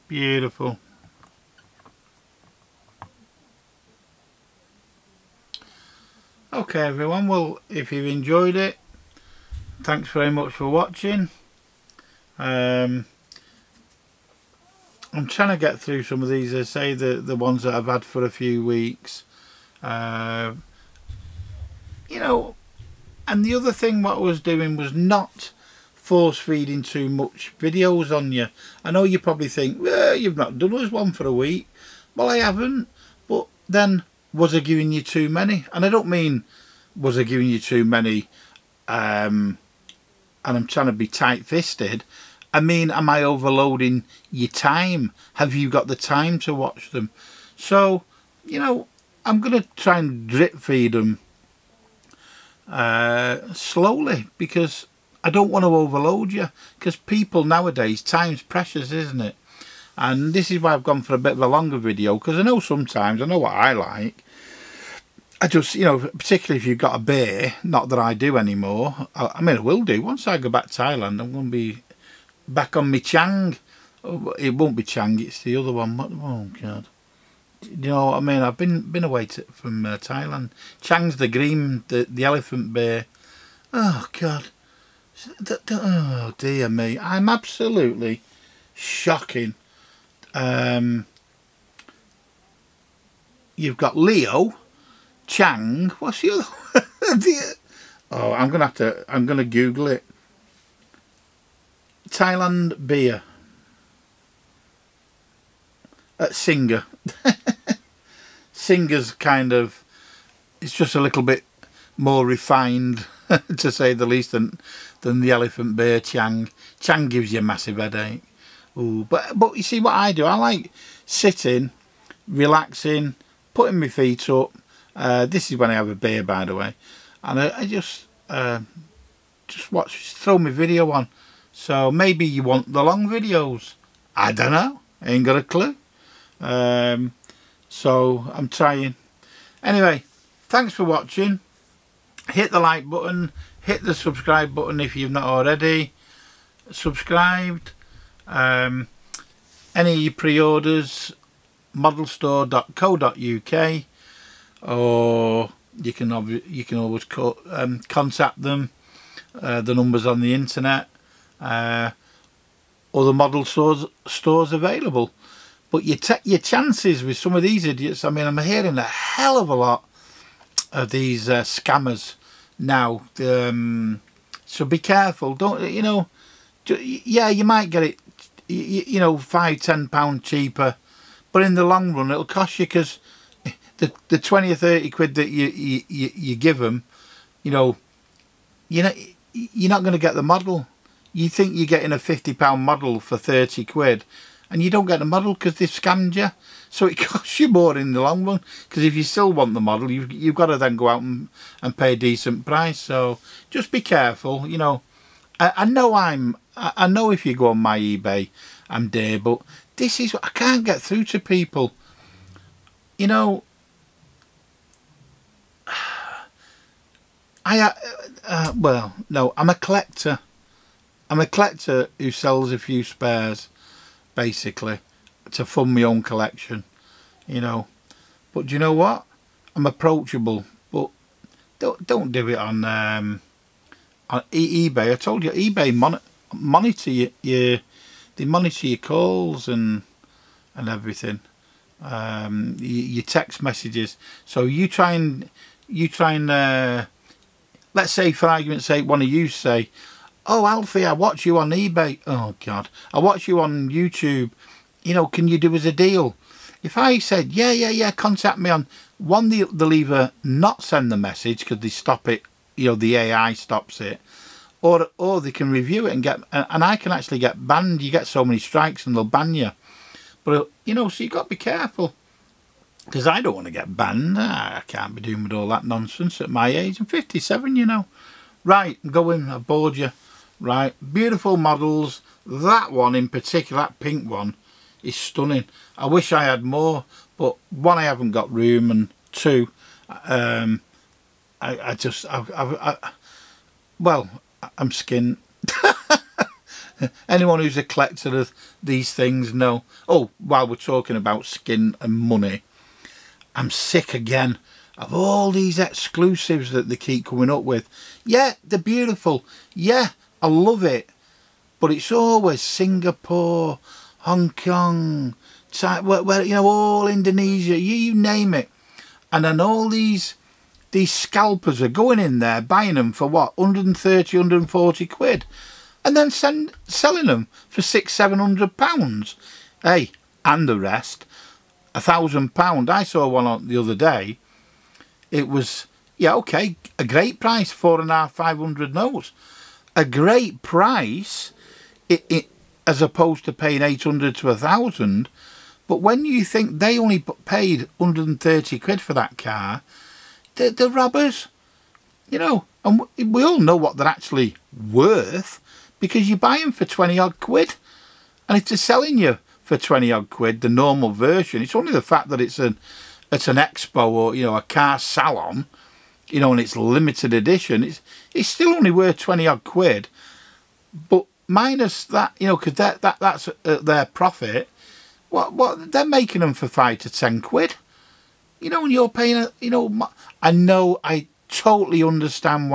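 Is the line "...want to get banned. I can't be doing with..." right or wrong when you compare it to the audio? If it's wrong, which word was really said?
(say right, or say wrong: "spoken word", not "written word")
right.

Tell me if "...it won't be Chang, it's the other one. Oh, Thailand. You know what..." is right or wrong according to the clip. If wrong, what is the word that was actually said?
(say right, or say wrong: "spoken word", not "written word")
wrong: "God", not "Thailand".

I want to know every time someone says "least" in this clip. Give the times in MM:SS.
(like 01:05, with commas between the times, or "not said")
01:54.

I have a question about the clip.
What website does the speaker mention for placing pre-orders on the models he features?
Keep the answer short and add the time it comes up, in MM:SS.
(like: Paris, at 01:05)
modelstore.co.uk, at 02:31.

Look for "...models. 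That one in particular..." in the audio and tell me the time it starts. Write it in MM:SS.
04:41.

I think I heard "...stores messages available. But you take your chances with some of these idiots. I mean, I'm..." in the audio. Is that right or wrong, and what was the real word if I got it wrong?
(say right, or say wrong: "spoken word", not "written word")
wrong: "stores", not "messages".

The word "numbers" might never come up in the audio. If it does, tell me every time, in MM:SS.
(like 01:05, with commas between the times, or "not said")
02:39.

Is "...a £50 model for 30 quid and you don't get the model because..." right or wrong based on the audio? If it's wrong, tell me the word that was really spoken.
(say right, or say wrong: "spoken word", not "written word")
right.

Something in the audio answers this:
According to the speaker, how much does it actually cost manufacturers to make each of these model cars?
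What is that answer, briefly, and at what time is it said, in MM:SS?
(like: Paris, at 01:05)
£5 to £10, at 06:16.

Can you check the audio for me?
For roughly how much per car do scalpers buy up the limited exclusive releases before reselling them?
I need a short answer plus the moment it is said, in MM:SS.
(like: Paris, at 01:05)
£130 to £140, at 05:23.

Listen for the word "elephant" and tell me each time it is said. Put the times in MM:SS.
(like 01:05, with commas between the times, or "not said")
01:22, 01:55.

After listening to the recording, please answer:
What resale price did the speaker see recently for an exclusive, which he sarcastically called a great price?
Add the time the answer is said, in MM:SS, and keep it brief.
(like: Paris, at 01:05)
£450 to £500, at 05:37.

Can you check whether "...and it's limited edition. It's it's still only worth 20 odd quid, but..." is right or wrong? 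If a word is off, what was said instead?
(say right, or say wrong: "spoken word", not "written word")
right.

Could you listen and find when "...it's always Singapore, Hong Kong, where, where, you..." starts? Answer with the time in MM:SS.
05:11.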